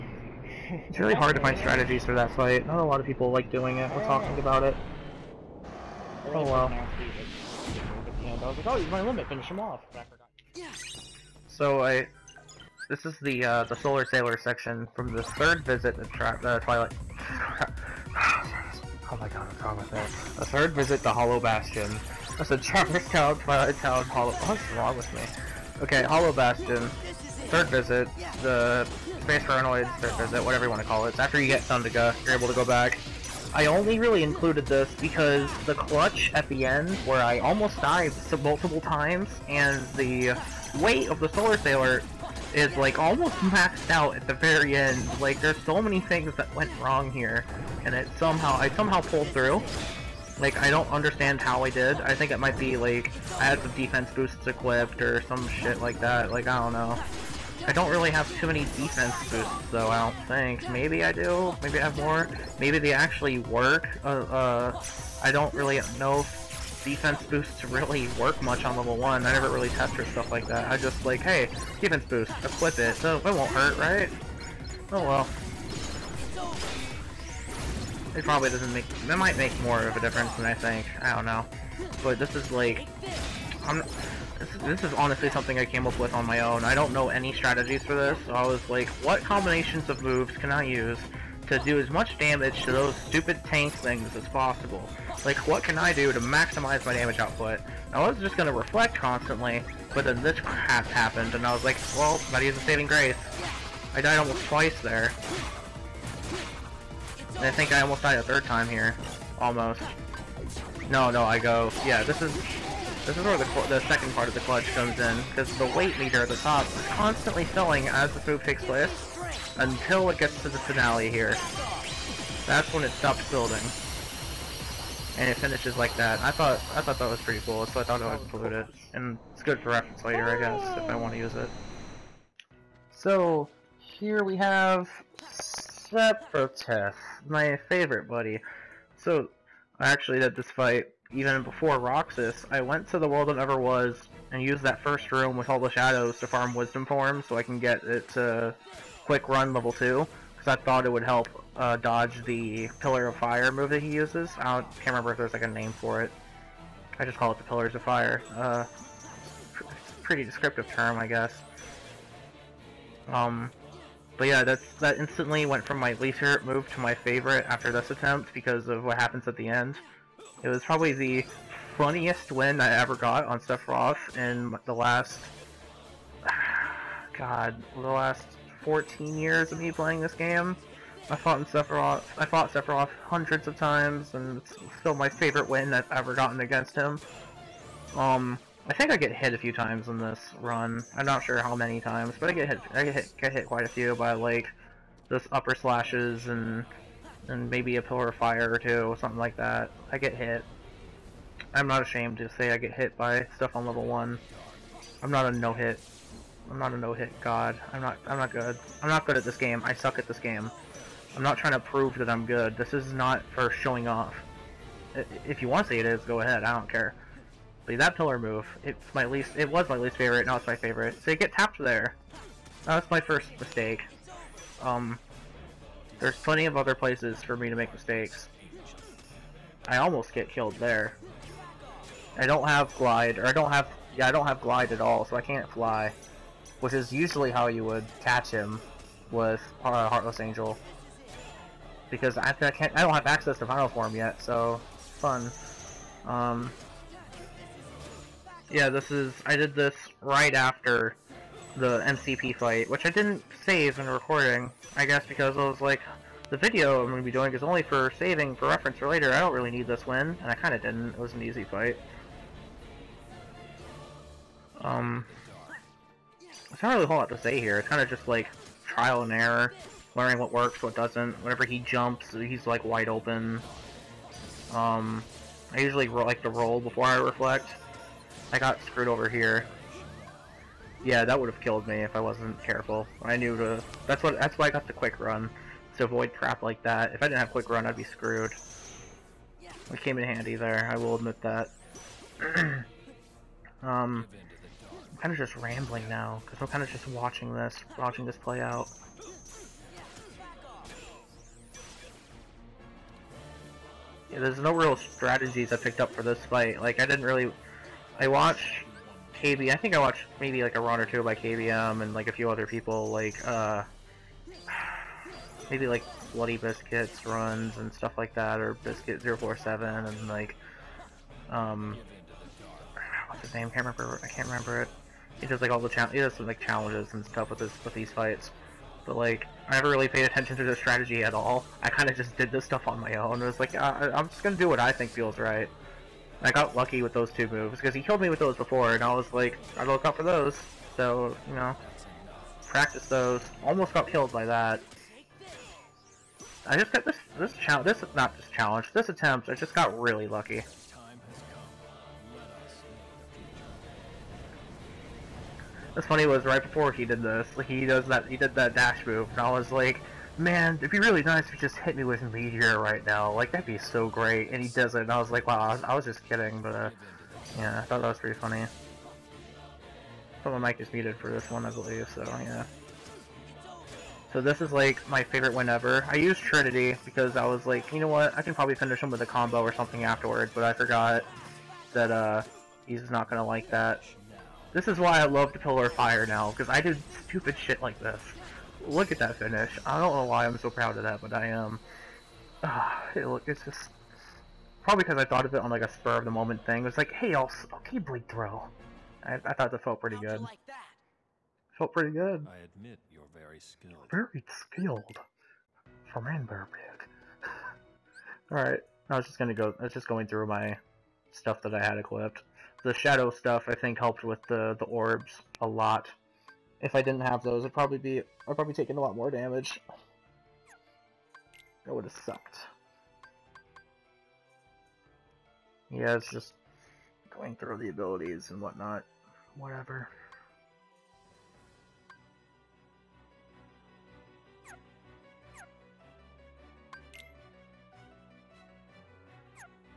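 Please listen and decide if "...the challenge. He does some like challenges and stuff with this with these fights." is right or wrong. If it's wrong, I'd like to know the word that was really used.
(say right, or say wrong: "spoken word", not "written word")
right.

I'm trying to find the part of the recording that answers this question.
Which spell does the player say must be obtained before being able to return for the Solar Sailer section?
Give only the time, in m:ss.
0:31.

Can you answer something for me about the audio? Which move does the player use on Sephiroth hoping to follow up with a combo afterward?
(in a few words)
Trinity.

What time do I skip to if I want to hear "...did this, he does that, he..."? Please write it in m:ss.
5:56.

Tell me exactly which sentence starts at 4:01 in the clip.
Because I, I, can't, I don't have access to Final Form yet, so fun.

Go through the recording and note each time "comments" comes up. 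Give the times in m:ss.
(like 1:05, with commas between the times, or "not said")
not said.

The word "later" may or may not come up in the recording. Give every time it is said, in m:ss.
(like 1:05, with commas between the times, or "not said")
2:10, 4:18.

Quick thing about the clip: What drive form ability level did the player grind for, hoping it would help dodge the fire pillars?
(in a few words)
quick run level 2.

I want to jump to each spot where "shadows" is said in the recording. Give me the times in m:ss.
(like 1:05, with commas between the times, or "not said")
2:25, 6:52.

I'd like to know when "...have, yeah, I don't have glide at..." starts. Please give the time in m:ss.
3:53.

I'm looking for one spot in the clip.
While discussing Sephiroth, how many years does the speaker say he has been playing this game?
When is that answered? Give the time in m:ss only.
2:58.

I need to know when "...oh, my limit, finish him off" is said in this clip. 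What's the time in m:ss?
0:08.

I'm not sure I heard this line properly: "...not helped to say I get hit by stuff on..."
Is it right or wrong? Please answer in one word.
wrong.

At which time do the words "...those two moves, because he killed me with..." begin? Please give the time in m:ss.
5:36.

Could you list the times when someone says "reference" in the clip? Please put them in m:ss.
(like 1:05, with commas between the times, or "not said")
2:09, 4:18.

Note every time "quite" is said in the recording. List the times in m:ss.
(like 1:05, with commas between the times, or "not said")
3:13.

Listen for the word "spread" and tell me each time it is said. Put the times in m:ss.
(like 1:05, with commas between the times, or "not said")
not said.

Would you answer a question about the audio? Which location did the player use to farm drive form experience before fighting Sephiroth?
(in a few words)
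The World That Never Was.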